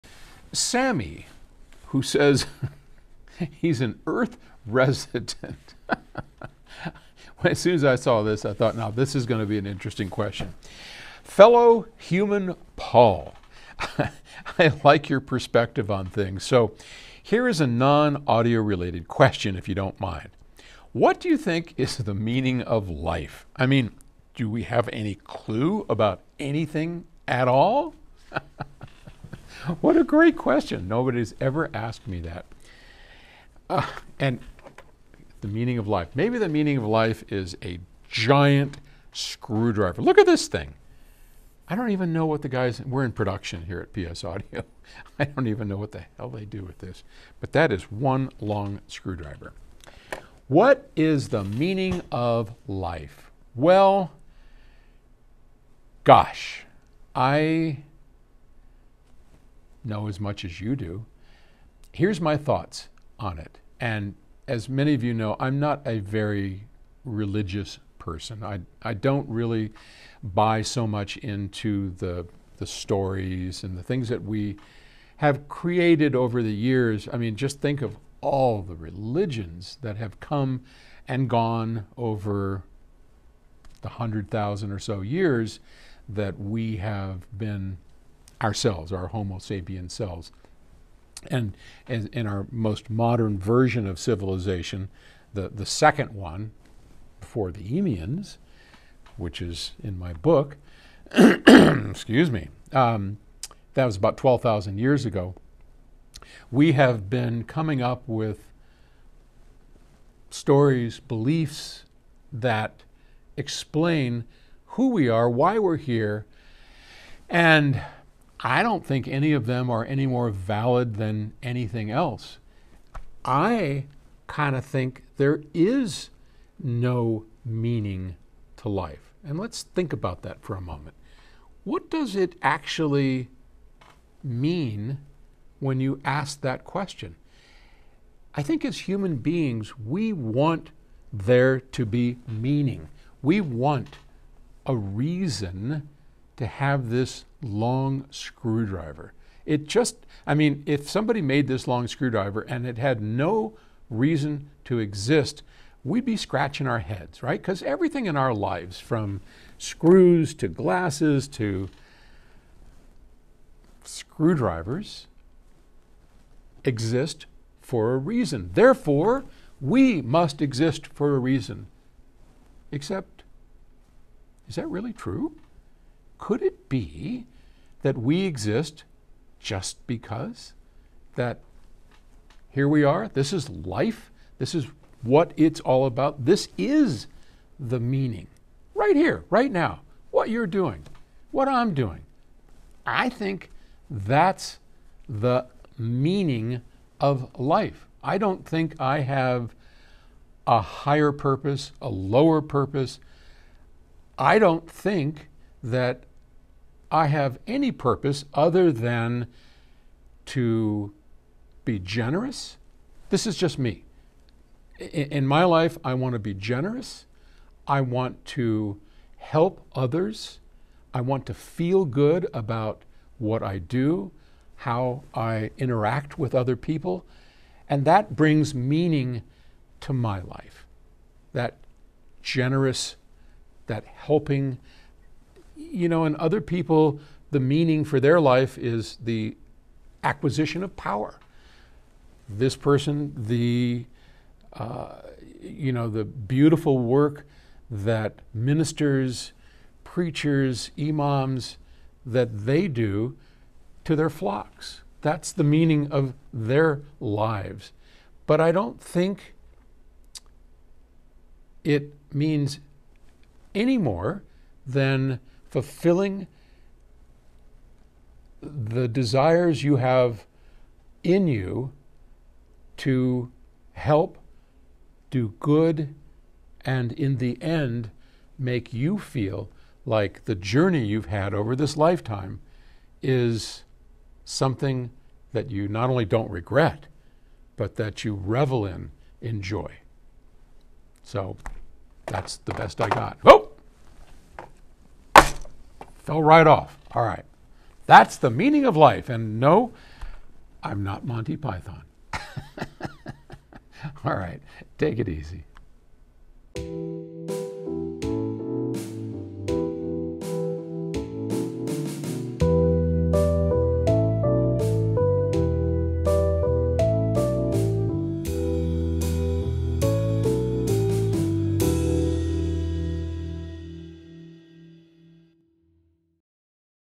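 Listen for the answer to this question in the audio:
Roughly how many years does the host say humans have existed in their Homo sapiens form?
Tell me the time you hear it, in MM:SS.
01:23.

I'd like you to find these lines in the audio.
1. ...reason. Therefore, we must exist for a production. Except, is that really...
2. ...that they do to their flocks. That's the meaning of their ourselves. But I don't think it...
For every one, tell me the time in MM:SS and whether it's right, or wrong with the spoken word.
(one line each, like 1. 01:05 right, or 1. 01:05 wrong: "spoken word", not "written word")
1. 02:47 wrong: "reason", not "production"
2. 04:12 wrong: "lives", not "ourselves".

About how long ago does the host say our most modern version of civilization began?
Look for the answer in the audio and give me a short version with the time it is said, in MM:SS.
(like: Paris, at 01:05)
12,000 years ago, at 01:44.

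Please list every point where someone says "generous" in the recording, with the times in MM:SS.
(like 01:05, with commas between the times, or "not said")
03:31, 03:36, 03:52.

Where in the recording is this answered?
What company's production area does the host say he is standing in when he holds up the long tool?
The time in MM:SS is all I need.
00:43.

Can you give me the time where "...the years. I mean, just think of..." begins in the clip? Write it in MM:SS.
01:16.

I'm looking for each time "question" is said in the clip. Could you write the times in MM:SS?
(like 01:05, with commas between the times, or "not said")
00:10, 00:19, 00:30, 02:16.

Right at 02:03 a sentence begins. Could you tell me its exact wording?
I kind of think there is no meaning to life.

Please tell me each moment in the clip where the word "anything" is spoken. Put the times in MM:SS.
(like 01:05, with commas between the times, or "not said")
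00:26, 02:01.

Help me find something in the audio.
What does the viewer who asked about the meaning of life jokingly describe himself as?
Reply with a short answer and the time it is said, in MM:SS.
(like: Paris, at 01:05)
Earth resident, at 00:04.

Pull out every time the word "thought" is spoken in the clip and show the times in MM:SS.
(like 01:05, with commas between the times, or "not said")
00:08, 01:02.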